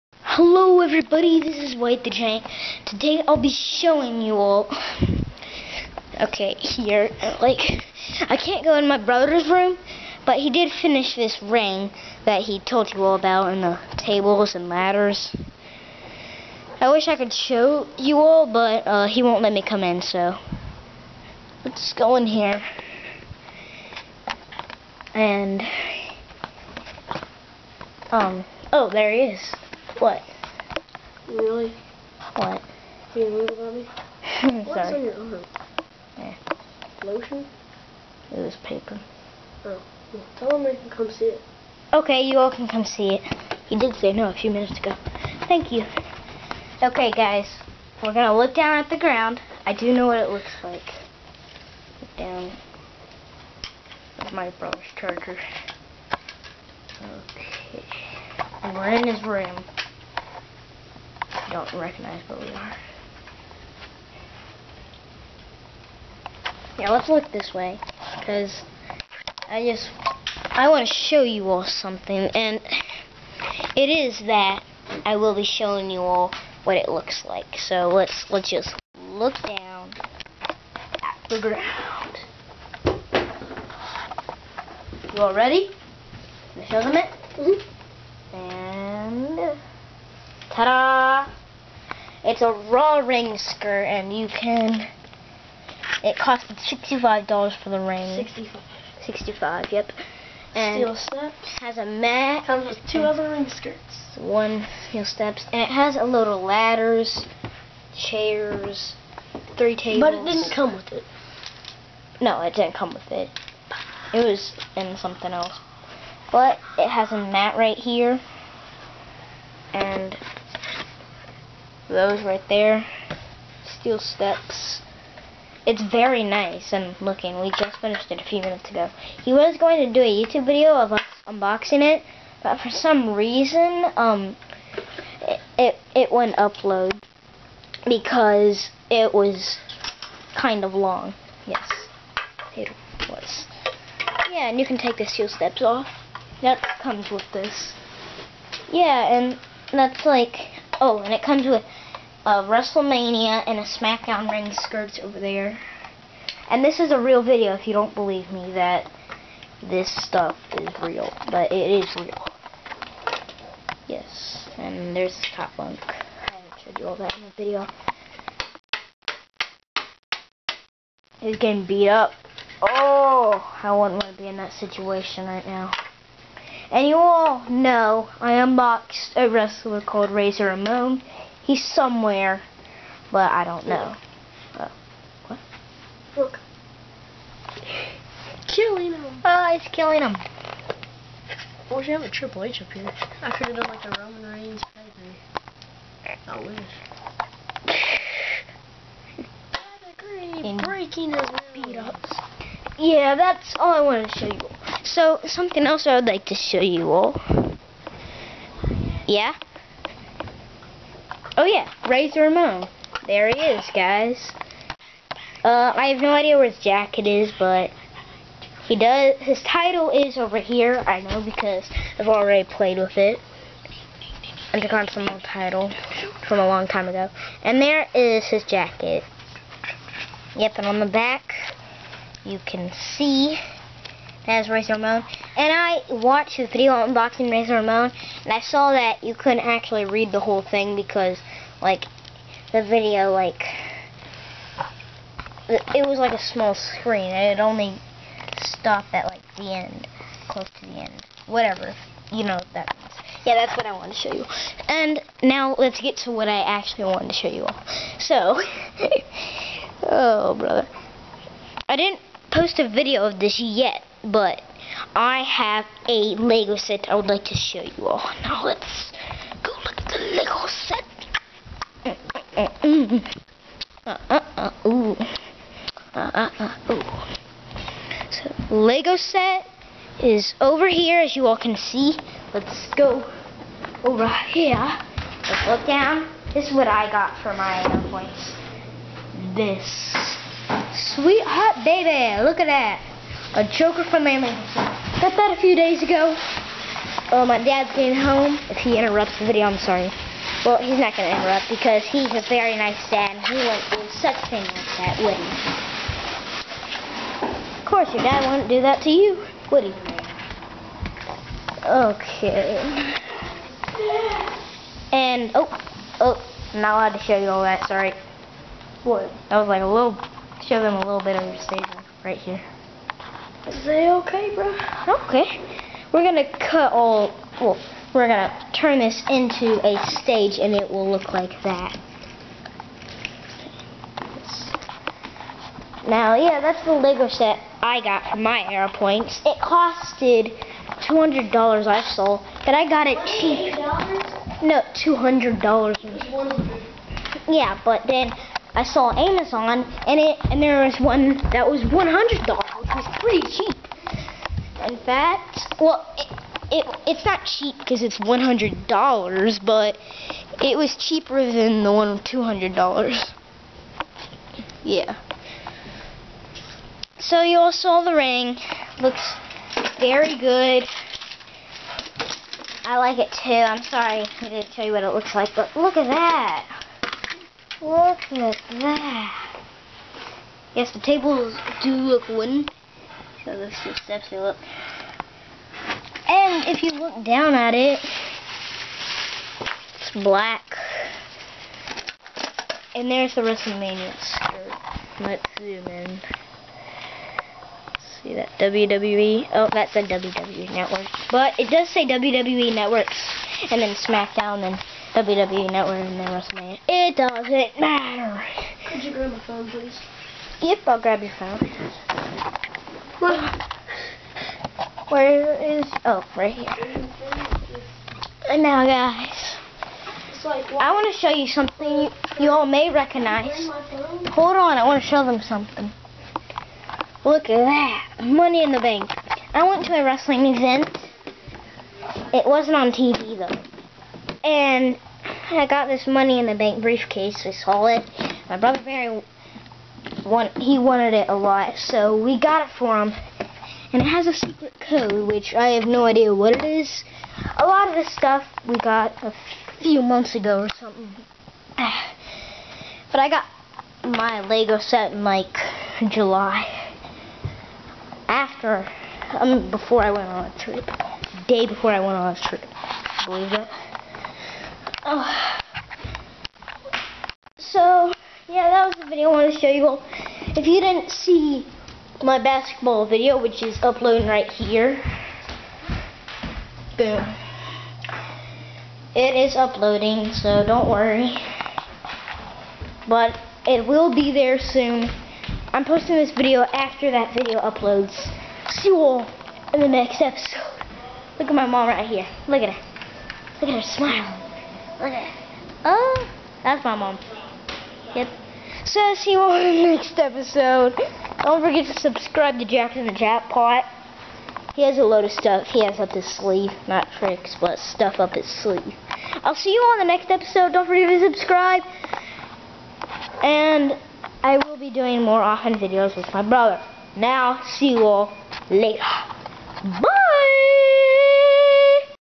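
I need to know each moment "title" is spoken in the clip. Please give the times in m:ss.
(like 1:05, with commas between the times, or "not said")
3:39, 3:45.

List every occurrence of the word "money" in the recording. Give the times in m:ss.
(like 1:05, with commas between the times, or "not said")
7:08, 7:15.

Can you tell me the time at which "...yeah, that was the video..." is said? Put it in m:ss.
7:48.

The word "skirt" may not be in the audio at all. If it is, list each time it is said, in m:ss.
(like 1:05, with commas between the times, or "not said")
1:33, 1:43, 2:34, 6:33.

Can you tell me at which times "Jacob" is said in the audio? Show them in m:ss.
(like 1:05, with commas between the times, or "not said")
not said.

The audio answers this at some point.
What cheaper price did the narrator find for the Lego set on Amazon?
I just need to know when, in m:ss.
5:51.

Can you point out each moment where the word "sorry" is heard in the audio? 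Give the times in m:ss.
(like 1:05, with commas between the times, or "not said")
0:34, 4:59, 5:17, 6:13.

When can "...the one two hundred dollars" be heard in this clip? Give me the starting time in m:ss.
6:01.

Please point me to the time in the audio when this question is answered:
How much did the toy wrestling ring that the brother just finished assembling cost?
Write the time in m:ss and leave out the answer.
1:36.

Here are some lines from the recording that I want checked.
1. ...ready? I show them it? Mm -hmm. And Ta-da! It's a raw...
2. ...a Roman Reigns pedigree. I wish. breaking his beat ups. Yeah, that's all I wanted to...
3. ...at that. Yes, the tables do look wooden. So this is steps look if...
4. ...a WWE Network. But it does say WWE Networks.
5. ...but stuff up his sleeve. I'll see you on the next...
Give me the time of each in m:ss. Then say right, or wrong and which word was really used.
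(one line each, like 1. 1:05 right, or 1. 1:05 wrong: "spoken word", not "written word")
1. 1:25 right
2. 3:13 right
3. 6:18 right
4. 6:39 right
5. 8:27 right.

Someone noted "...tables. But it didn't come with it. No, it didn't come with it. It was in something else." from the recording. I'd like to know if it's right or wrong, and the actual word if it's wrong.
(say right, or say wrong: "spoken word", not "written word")
right.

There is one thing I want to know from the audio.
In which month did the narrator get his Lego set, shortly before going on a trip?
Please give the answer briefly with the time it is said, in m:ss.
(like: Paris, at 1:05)
July, at 7:35.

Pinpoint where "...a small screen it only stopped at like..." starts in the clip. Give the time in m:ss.
4:06.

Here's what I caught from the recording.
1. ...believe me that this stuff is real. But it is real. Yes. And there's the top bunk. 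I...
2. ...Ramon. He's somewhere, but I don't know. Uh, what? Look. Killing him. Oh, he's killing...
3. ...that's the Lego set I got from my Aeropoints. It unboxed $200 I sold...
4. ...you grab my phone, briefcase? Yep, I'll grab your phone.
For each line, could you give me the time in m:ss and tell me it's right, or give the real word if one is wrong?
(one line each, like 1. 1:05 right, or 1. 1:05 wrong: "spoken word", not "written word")
1. 2:37 right
2. 3:00 right
3. 5:36 wrong: "costed", not "unboxed"
4. 6:48 wrong: "please", not "briefcase".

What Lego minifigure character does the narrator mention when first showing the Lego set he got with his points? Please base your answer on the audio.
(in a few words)
Joker.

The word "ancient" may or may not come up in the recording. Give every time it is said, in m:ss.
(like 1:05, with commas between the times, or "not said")
not said.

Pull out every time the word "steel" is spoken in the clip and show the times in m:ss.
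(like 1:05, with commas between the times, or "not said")
1:40, 1:44, 2:03, 2:25.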